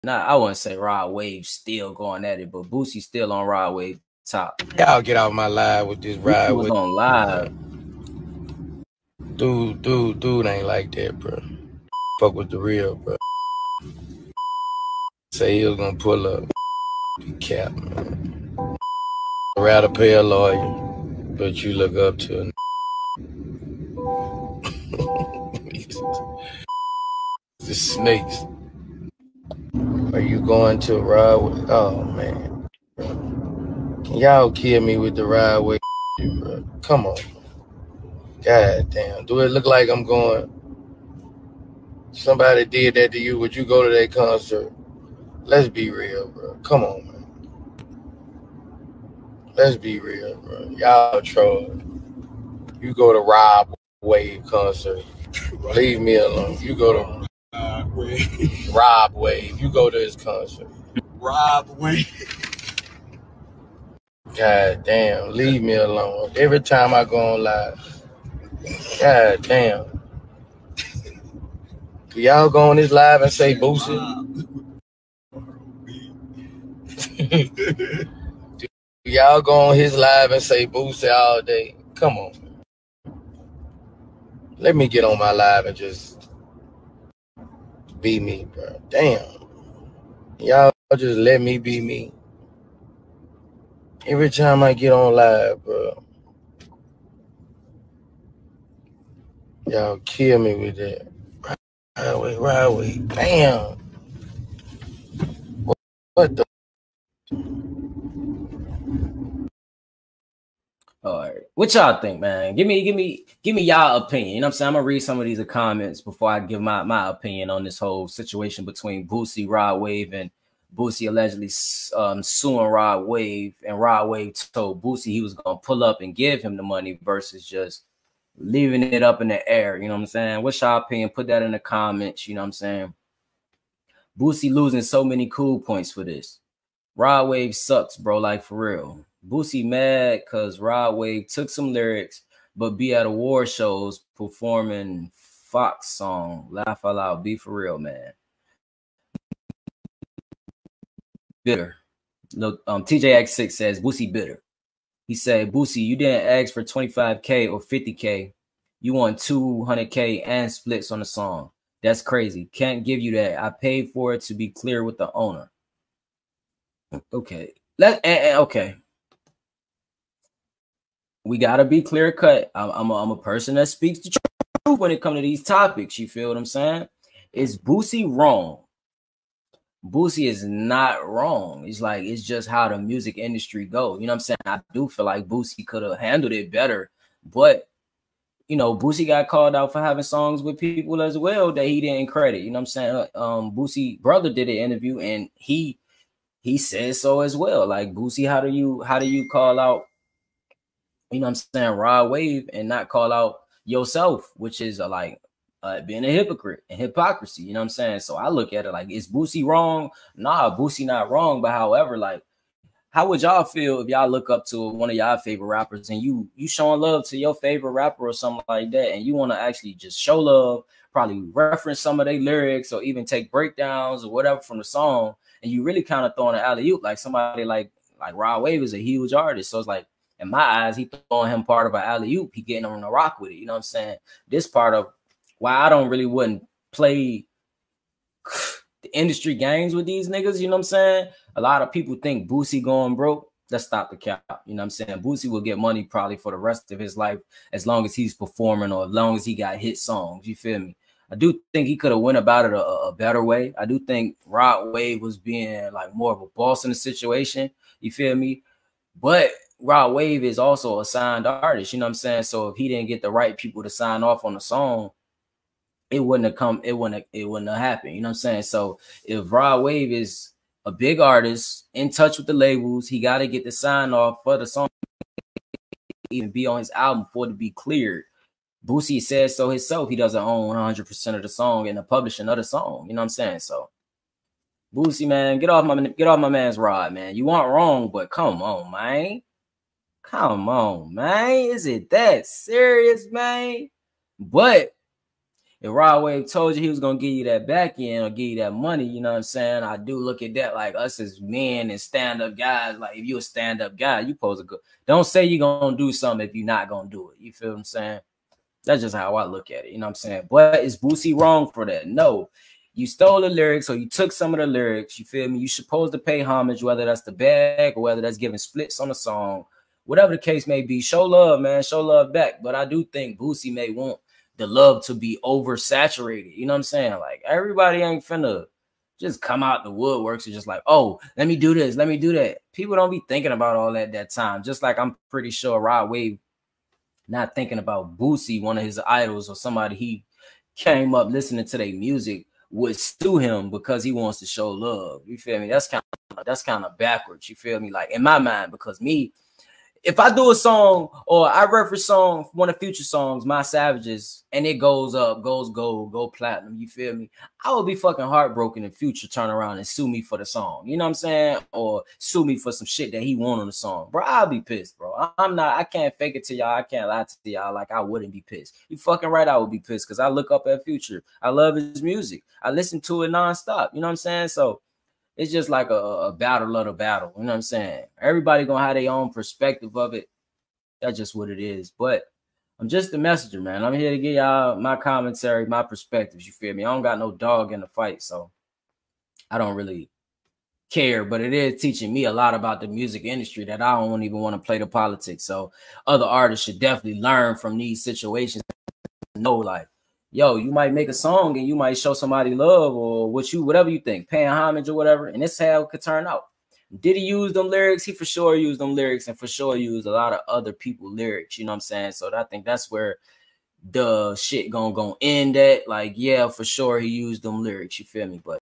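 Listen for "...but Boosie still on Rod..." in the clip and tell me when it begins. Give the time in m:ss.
0:02.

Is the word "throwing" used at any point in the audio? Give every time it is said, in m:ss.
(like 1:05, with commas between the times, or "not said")
3:46, 3:51.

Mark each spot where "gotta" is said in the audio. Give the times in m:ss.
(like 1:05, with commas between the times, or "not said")
2:51, 4:32.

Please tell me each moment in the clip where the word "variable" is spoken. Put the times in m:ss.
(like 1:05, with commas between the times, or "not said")
not said.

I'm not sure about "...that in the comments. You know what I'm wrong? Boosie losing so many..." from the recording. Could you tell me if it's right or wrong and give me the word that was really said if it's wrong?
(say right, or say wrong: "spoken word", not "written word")
wrong: "saying", not "wrong".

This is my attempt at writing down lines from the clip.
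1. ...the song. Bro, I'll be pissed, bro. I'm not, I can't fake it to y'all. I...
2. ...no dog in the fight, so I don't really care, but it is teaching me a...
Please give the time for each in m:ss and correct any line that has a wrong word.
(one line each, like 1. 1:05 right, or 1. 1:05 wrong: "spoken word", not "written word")
1. 6:03 right
2. 6:26 right.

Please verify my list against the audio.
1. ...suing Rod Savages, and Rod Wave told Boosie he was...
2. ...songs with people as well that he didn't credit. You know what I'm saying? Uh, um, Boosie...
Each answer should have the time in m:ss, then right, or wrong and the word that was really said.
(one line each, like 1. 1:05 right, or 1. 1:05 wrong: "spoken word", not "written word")
1. 2:02 wrong: "Wave", not "Savages"
2. 3:10 right.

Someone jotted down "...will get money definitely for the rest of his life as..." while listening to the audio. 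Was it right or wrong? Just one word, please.
wrong.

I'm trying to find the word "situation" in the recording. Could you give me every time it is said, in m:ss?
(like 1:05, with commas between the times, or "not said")
1:58, 4:16, 6:37.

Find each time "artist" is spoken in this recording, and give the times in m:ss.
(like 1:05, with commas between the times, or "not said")
3:49, 4:21, 4:30, 6:36.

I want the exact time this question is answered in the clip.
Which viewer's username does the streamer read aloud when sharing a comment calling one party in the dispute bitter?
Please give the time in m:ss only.
2:32.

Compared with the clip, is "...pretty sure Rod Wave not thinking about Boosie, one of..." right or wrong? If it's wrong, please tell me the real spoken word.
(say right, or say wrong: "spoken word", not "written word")
right.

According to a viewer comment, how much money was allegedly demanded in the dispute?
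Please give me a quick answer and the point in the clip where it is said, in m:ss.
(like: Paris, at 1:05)
200K, at 2:39.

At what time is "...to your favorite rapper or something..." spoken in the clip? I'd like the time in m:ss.
3:37.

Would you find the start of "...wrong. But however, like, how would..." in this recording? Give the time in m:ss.
3:31.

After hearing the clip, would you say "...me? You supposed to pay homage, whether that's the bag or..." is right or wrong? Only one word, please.
right.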